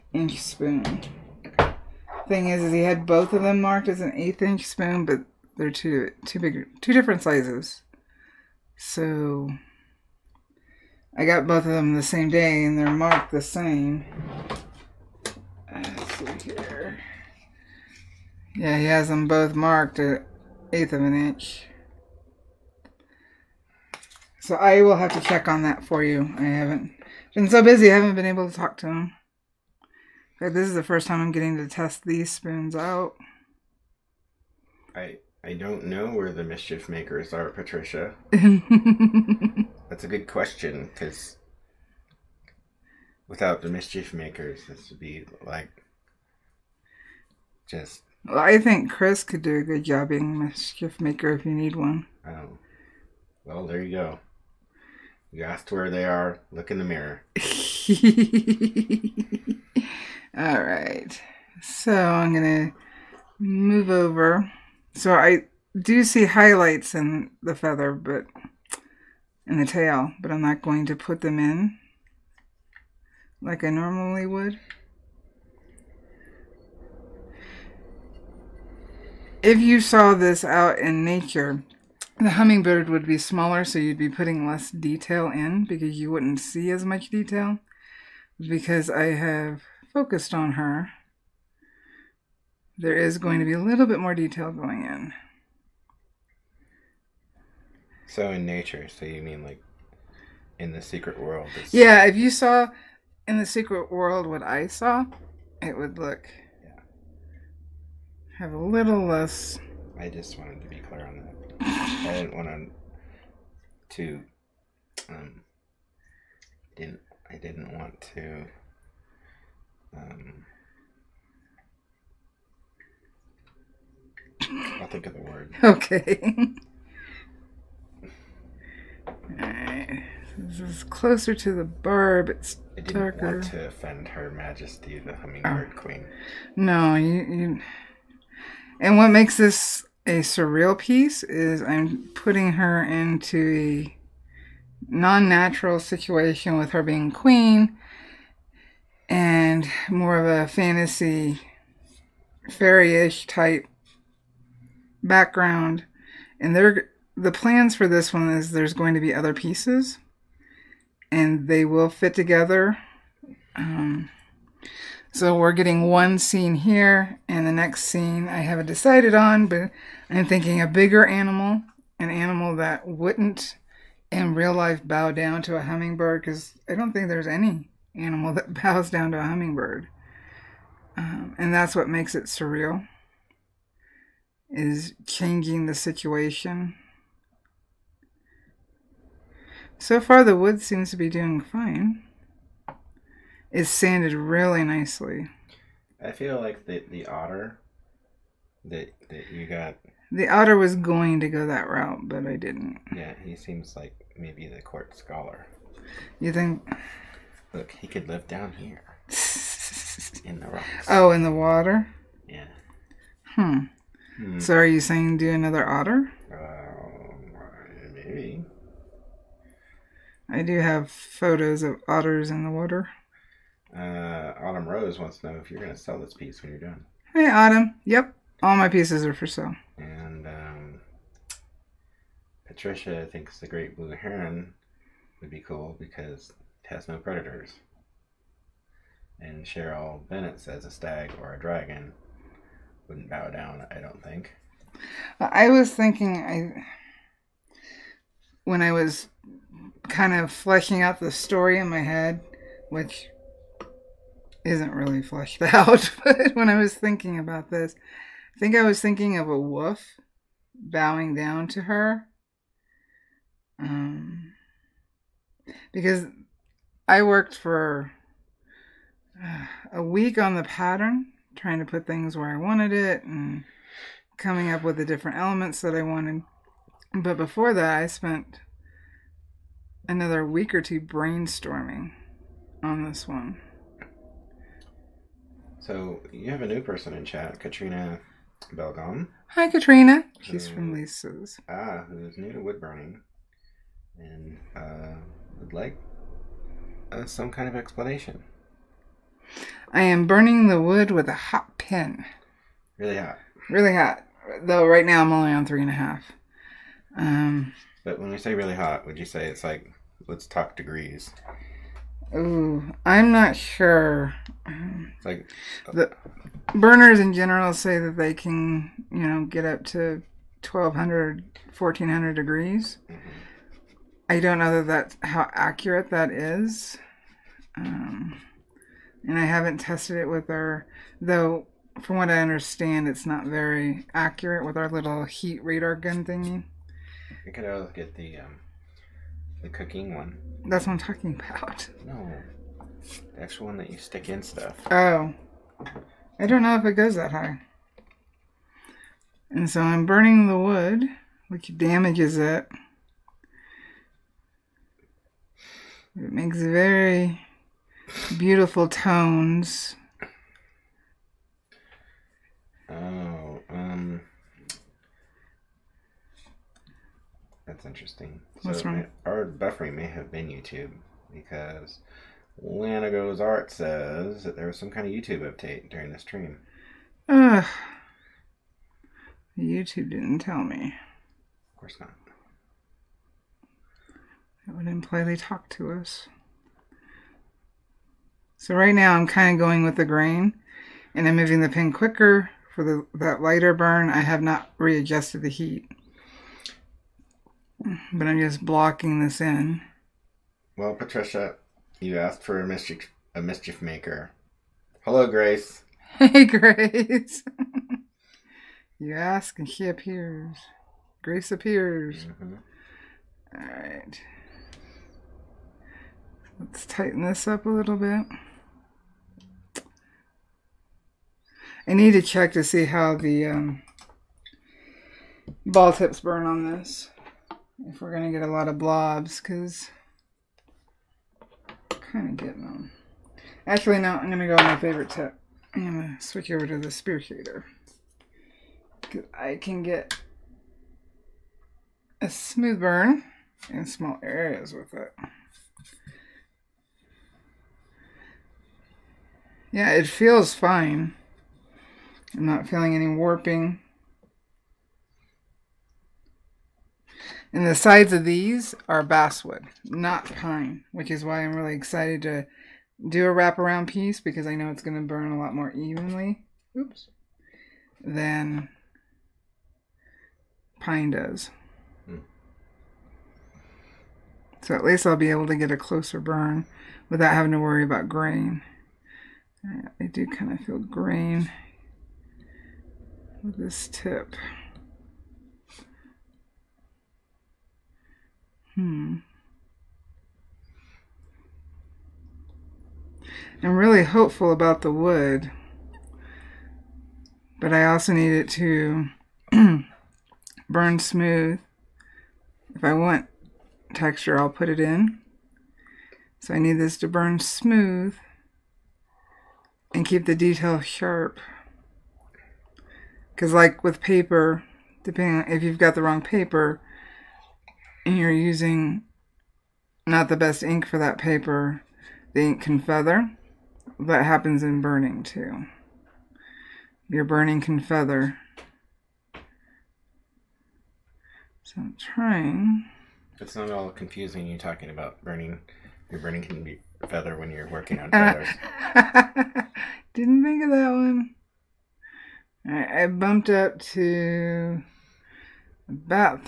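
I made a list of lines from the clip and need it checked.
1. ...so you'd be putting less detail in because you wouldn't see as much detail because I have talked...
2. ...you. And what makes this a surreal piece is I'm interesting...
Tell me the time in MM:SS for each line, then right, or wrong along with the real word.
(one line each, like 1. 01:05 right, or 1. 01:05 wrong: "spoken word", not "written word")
1. 01:23 wrong: "focused", not "talked"
2. 02:17 wrong: "putting", not "interesting".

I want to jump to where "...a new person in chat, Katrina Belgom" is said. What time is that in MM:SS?
04:46.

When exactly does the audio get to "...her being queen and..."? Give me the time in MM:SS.
02:26.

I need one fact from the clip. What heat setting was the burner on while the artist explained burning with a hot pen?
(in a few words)
3.5.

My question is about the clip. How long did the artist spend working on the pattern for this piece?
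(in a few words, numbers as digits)
a week.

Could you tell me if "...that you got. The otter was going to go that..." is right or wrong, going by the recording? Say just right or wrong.
right.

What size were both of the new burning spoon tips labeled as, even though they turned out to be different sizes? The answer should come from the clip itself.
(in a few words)
1/8 inch.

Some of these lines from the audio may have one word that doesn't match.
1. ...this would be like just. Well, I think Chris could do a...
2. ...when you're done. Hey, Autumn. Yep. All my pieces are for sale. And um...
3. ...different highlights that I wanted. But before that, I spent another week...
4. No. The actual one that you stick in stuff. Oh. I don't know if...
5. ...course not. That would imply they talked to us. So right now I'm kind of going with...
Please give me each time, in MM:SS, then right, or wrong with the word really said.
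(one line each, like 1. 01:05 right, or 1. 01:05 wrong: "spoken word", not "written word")
1. 00:44 right
2. 03:46 right
3. 04:34 wrong: "elements", not "highlights"
4. 05:41 right
5. 06:21 right.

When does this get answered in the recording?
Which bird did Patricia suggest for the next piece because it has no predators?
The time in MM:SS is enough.
03:53.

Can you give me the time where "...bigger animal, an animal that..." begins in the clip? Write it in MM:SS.
02:50.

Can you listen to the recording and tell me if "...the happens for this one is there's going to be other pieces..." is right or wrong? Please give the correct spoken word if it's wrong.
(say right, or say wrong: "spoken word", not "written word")
wrong: "plans", not "happens".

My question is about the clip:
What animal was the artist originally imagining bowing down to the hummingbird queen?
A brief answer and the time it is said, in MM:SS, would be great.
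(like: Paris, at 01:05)
wolf, at 04:19.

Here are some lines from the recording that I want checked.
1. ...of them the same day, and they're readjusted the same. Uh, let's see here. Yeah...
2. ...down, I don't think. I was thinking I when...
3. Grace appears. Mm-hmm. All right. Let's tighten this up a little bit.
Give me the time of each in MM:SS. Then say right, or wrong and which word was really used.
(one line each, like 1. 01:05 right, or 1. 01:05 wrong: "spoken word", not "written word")
1. 00:11 wrong: "marked", not "readjusted"
2. 04:03 right
3. 06:51 right.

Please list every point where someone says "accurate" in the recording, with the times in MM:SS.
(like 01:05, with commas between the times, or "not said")
05:25, 05:33.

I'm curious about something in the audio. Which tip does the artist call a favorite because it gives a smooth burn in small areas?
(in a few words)
spear.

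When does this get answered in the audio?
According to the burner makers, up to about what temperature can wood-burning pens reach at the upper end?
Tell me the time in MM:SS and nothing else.
05:21.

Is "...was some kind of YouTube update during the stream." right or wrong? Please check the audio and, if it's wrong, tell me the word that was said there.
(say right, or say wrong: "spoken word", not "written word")
right.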